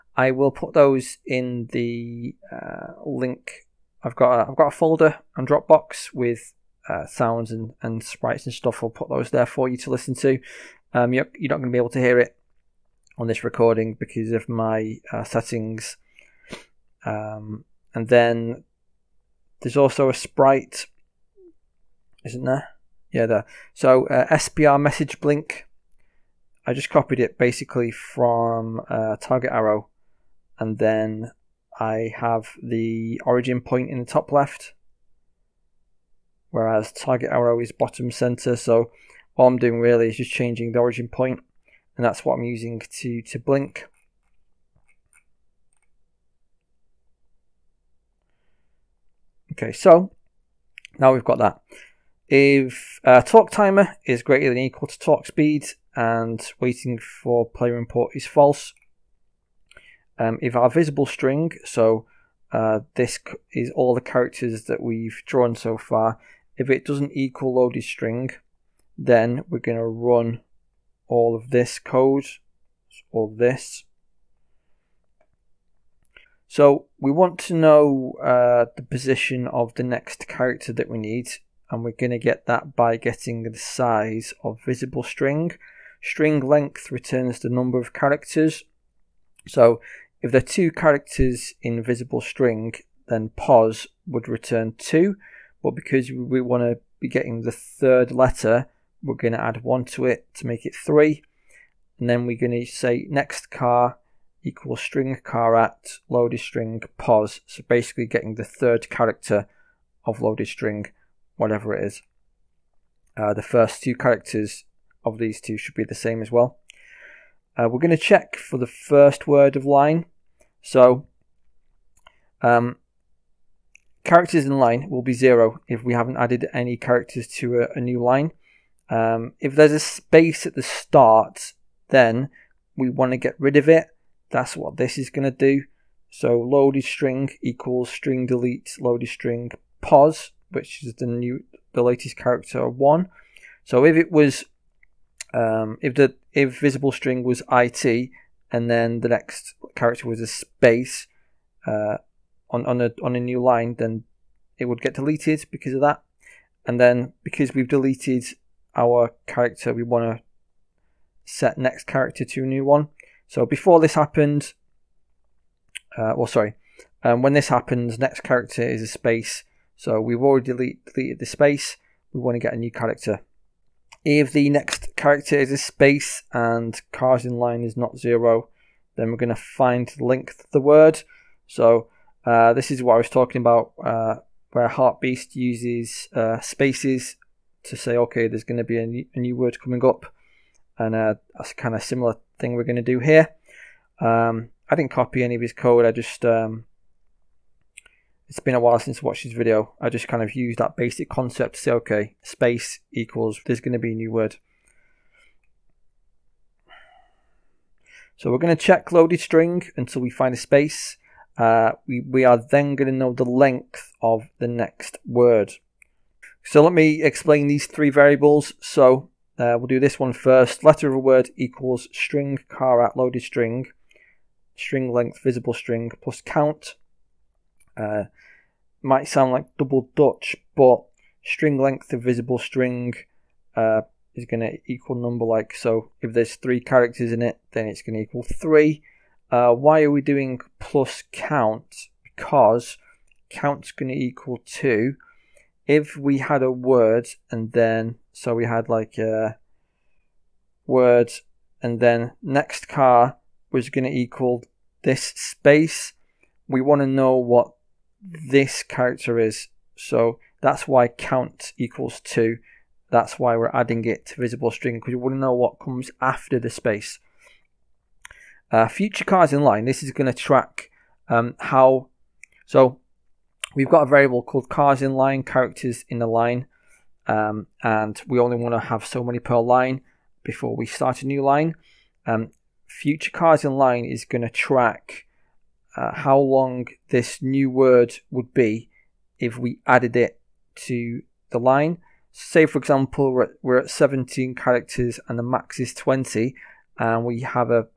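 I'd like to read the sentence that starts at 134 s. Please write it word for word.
That's what this is going to do.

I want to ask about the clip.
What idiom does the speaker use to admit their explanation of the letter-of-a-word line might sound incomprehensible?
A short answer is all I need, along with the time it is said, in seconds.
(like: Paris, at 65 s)
double Dutch, at 229 s.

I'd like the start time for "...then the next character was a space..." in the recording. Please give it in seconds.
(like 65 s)
148 s.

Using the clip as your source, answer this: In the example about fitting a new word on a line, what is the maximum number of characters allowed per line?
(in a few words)
20.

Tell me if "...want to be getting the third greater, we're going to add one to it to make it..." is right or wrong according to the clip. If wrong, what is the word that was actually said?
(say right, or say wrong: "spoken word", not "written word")
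wrong: "letter", not "greater".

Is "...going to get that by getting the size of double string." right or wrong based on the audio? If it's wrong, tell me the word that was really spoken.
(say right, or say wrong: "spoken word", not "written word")
wrong: "visible", not "double".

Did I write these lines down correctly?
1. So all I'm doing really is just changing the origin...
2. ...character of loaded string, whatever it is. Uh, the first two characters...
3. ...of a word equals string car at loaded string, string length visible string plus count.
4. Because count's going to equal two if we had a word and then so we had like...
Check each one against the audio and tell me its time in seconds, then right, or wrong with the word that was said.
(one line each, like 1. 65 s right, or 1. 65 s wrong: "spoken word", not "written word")
1. 38 s right
2. 108 s right
3. 220 s right
4. 242 s right.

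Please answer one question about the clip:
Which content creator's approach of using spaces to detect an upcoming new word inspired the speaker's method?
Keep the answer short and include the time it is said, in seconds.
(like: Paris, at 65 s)
Heartbeast, at 184 s.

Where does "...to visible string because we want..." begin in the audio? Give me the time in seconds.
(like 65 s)
264 s.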